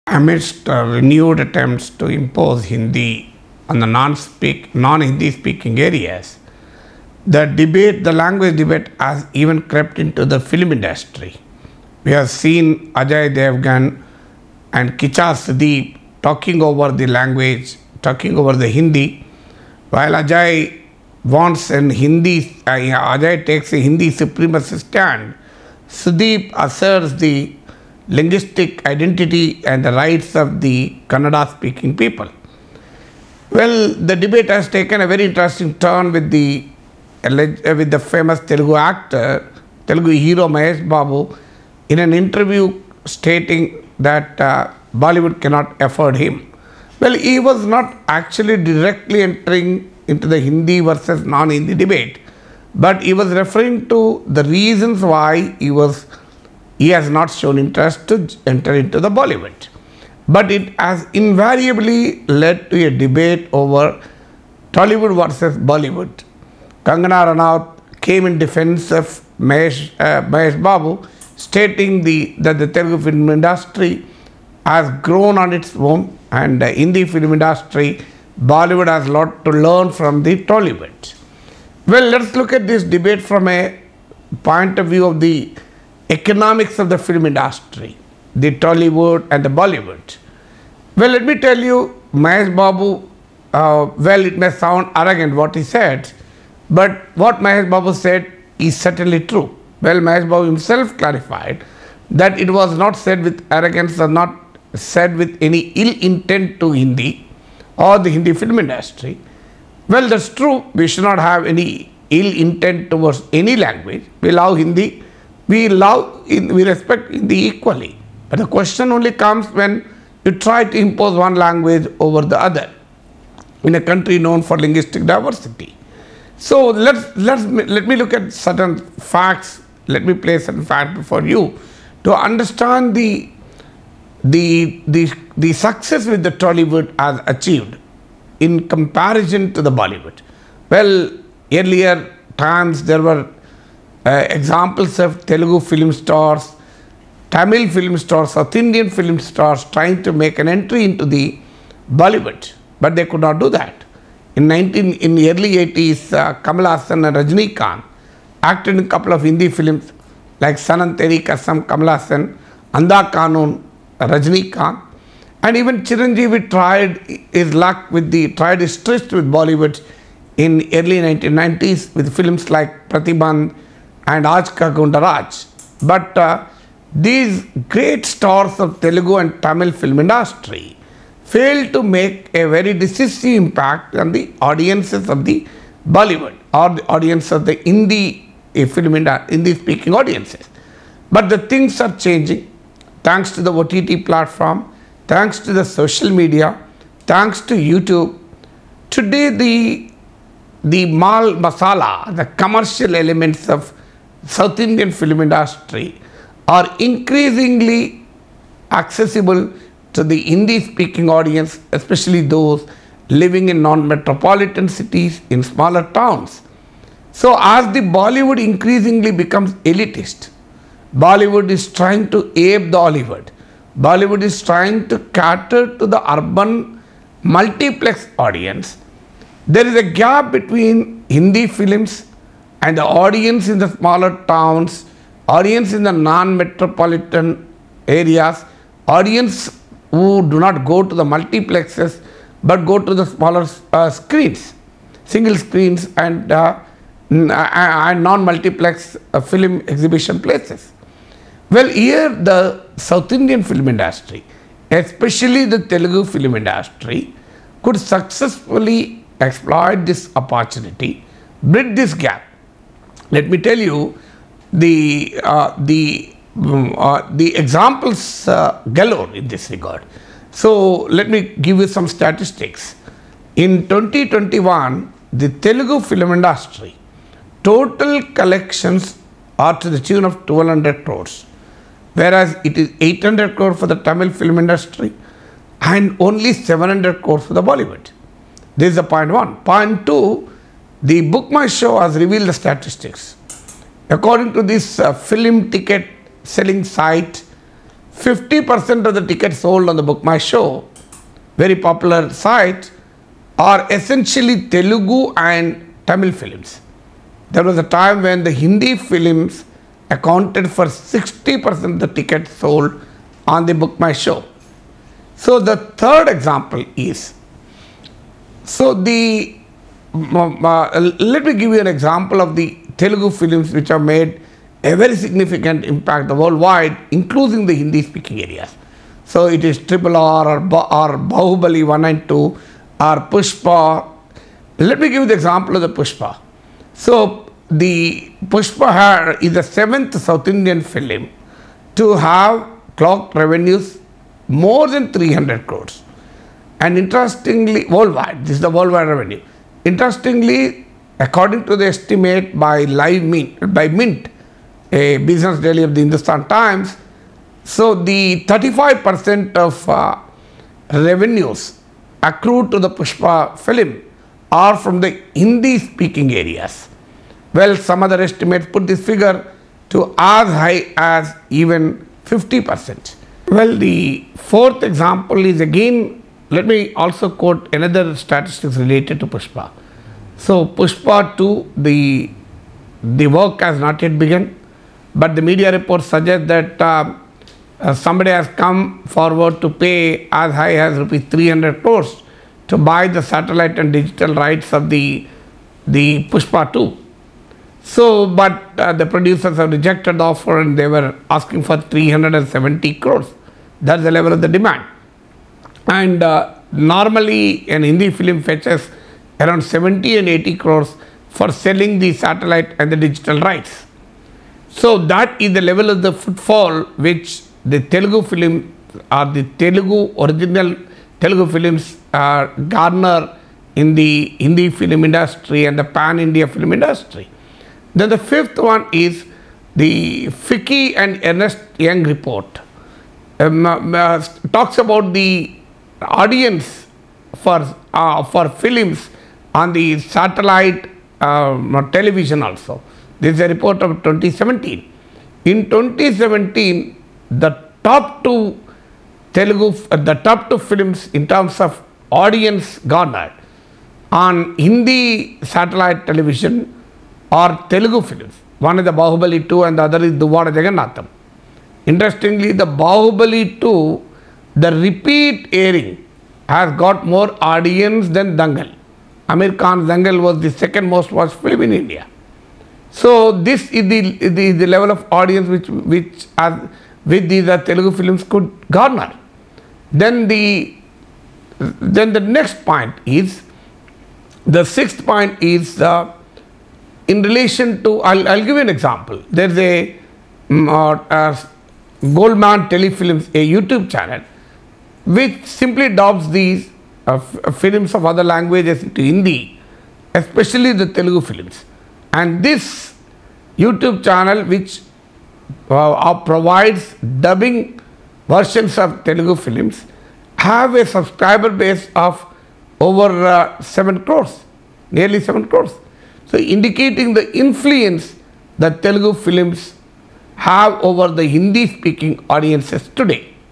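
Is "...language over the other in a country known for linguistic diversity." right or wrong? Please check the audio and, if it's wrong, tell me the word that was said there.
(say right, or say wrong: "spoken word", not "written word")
right.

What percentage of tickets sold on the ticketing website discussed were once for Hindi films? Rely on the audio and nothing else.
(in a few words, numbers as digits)
60%.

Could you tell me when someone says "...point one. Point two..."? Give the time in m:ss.
4:48.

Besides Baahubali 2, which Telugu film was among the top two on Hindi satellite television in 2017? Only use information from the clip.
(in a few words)
Duvvada Jagannadham.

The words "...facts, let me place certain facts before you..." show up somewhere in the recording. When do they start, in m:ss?
2:09.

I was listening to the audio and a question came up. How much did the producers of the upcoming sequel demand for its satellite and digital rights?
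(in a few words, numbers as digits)
370 crores.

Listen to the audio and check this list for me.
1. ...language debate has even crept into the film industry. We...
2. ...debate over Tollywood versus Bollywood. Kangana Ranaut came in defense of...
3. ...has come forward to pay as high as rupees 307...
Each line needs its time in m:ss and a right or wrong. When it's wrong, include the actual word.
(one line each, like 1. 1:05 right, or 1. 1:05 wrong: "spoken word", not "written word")
1. 0:08 right
2. 1:03 right
3. 6:28 wrong: "300", not "307".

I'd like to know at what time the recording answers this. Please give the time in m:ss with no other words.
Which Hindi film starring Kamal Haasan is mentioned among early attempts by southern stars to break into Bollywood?
2:40.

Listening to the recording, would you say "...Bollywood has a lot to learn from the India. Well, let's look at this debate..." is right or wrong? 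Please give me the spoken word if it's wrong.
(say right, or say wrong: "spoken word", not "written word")
wrong: "Tollywood", not "India".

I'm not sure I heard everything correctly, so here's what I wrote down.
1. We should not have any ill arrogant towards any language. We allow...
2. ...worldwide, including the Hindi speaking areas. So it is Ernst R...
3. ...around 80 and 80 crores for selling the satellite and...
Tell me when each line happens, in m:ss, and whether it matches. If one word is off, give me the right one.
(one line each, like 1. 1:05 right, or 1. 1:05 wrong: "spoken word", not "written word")
1. 1:50 wrong: "intent", not "arrogant"
2. 5:26 wrong: "Triple", not "Ernst"
3. 6:49 wrong: "70", not "80".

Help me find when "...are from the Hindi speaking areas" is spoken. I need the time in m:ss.
6:04.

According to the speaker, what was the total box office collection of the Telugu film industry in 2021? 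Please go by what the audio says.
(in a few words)
1200 crores.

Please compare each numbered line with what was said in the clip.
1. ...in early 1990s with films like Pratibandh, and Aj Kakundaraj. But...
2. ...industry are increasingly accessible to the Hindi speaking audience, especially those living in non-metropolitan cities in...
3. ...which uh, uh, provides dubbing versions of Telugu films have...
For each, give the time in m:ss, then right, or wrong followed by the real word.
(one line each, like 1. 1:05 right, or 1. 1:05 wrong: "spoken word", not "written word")
1. 2:50 right
2. 3:25 right
3. 8:24 right.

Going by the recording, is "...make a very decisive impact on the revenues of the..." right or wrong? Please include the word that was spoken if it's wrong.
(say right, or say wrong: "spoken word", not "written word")
wrong: "audiences", not "revenues".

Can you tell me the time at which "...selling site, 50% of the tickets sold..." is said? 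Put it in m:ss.
4:56.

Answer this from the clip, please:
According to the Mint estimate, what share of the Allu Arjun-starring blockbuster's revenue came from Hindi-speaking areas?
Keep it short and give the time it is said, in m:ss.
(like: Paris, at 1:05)
35%, at 5:58.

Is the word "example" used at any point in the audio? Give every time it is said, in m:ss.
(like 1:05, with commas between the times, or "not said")
2:24, 4:27, 5:16, 5:21, 5:35, 6:14, 8:08.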